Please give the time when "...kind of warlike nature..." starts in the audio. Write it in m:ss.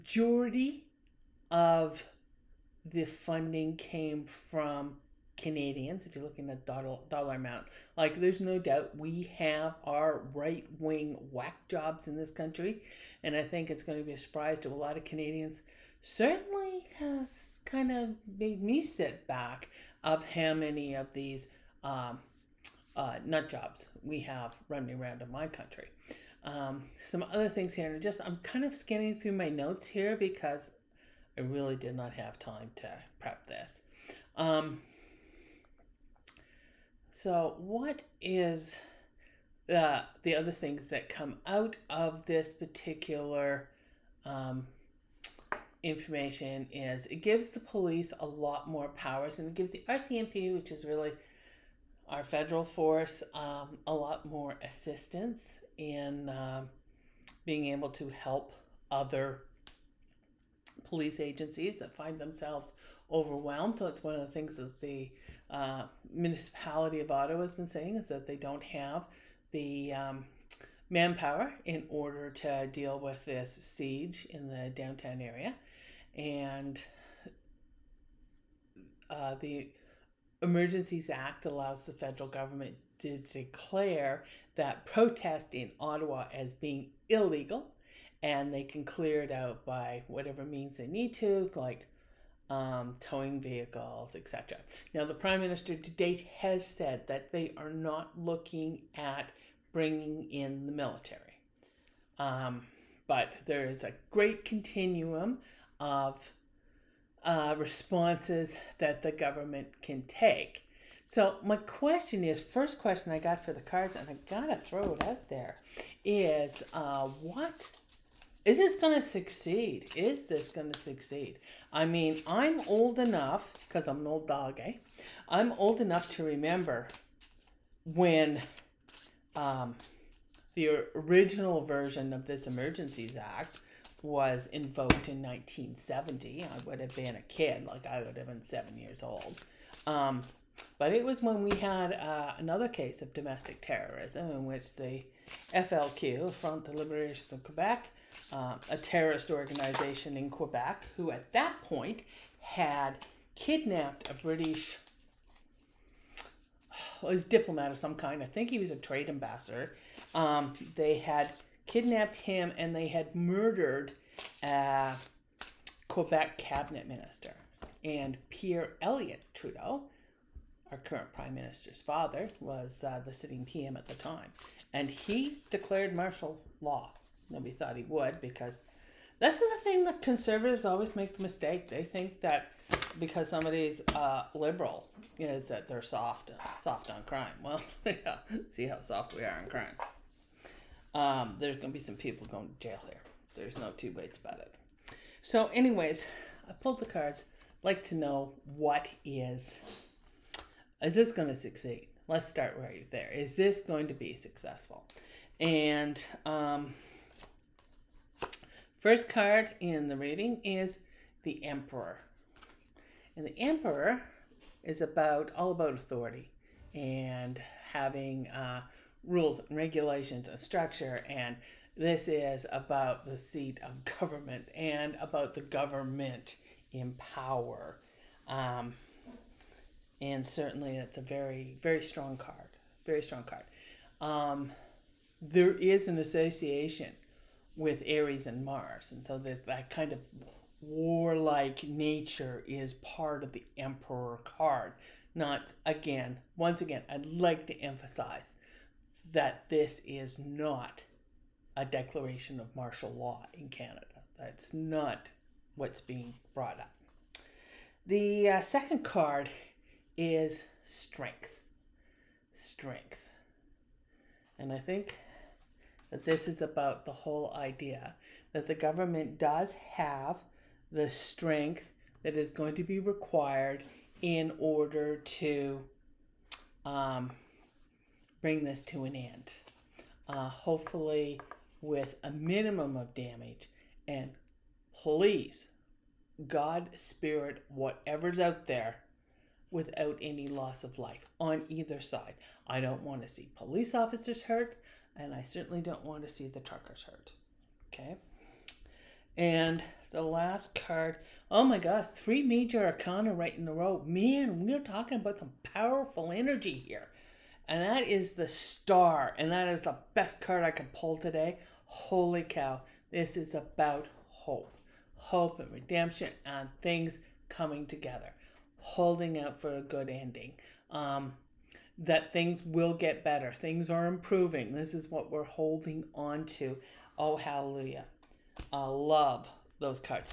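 3:59.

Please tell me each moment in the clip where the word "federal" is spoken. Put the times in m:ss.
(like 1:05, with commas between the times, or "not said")
0:52, 1:21.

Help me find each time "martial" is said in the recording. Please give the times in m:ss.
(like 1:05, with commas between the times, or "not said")
2:55, 4:12.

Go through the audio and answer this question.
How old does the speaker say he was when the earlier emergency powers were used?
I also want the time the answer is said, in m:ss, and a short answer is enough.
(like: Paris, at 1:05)
7, at 2:18.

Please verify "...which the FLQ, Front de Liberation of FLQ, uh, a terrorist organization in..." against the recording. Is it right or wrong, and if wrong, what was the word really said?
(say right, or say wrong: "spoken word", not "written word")
wrong: "Quebec", not "FLQ".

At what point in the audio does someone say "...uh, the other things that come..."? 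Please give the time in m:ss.
0:39.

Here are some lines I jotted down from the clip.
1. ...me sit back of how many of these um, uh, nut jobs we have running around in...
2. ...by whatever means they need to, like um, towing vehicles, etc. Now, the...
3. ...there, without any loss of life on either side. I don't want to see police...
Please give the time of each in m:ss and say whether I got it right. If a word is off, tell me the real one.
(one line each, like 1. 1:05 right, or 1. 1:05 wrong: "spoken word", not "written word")
1. 0:18 right
2. 1:29 right
3. 4:48 right.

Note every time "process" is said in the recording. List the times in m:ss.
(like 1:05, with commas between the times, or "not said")
not said.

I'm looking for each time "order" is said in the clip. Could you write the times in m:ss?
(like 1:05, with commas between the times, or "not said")
1:11, 4:34.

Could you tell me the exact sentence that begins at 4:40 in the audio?
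Uh, hopefully, with a minimum of damage.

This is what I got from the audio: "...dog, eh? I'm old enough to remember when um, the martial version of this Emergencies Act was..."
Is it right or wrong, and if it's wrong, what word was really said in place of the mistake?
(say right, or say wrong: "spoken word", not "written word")
wrong: "original", not "martial".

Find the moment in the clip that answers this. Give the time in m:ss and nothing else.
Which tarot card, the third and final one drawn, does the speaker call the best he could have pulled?
5:08.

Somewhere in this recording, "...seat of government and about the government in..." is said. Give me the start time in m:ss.
3:43.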